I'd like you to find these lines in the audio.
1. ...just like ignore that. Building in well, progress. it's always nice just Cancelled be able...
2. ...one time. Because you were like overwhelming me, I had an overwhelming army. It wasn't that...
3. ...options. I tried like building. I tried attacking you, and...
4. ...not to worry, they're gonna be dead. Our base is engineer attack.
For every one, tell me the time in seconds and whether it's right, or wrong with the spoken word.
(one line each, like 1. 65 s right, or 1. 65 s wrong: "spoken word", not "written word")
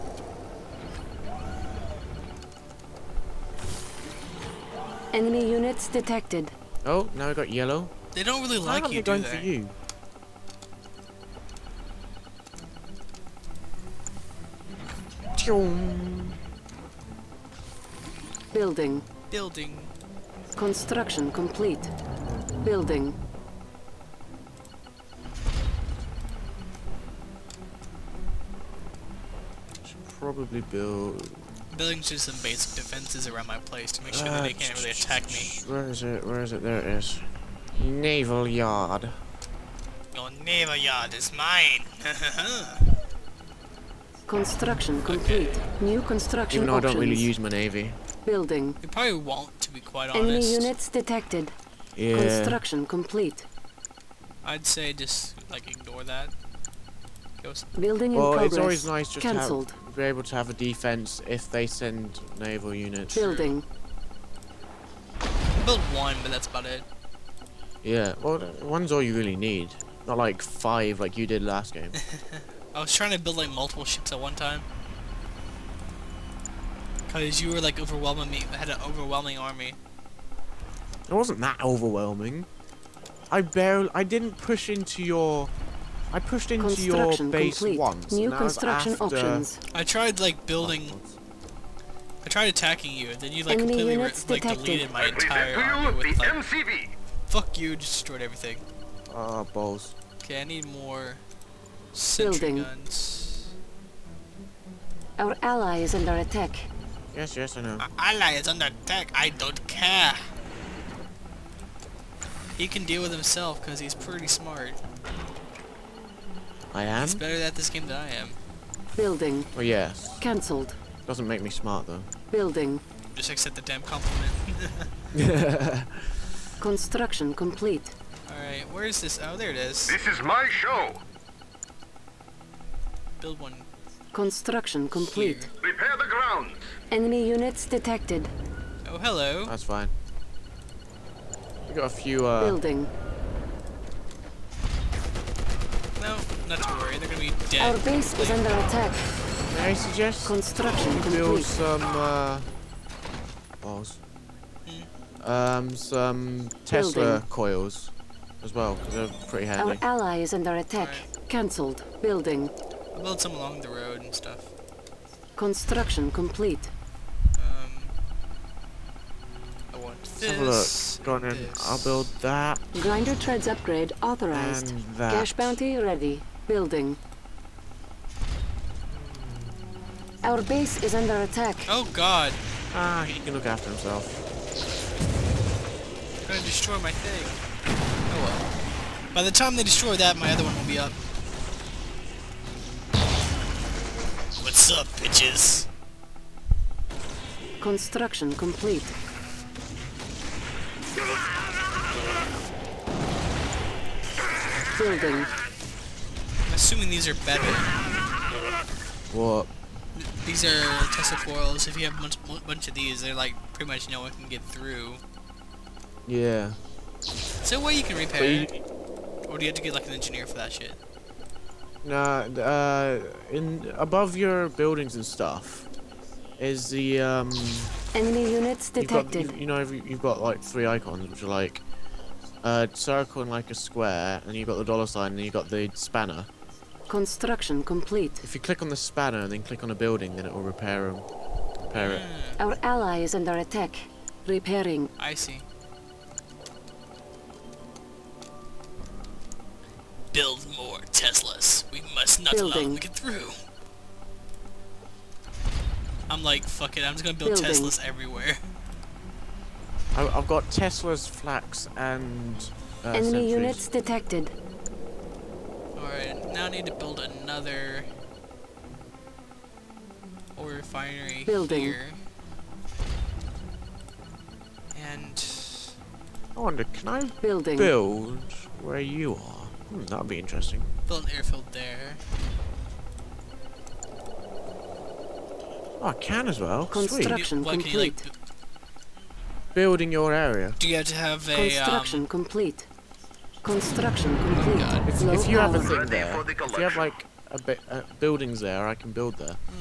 1. 54 s right
2. 74 s right
3. 88 s right
4. 146 s wrong: "under", not "engineer".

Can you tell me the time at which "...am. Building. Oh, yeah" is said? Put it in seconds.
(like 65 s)
118 s.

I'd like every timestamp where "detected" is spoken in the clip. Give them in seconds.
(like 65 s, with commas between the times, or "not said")
5 s, 50 s, 137 s, 228 s, 263 s.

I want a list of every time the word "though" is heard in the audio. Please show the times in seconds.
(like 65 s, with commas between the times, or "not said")
46 s, 121 s.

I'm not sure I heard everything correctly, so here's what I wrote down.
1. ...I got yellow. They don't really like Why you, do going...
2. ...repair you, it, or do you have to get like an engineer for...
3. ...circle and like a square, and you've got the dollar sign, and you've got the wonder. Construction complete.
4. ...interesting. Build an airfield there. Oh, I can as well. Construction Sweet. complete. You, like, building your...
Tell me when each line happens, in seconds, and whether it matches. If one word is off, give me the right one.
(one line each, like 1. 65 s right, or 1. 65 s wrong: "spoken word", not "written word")
1. 7 s right
2. 217 s right
3. 232 s wrong: "spanner", not "wonder"
4. 280 s right.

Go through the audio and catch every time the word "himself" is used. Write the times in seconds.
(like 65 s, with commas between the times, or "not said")
113 s, 183 s.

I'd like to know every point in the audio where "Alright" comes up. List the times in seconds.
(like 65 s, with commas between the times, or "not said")
128 s.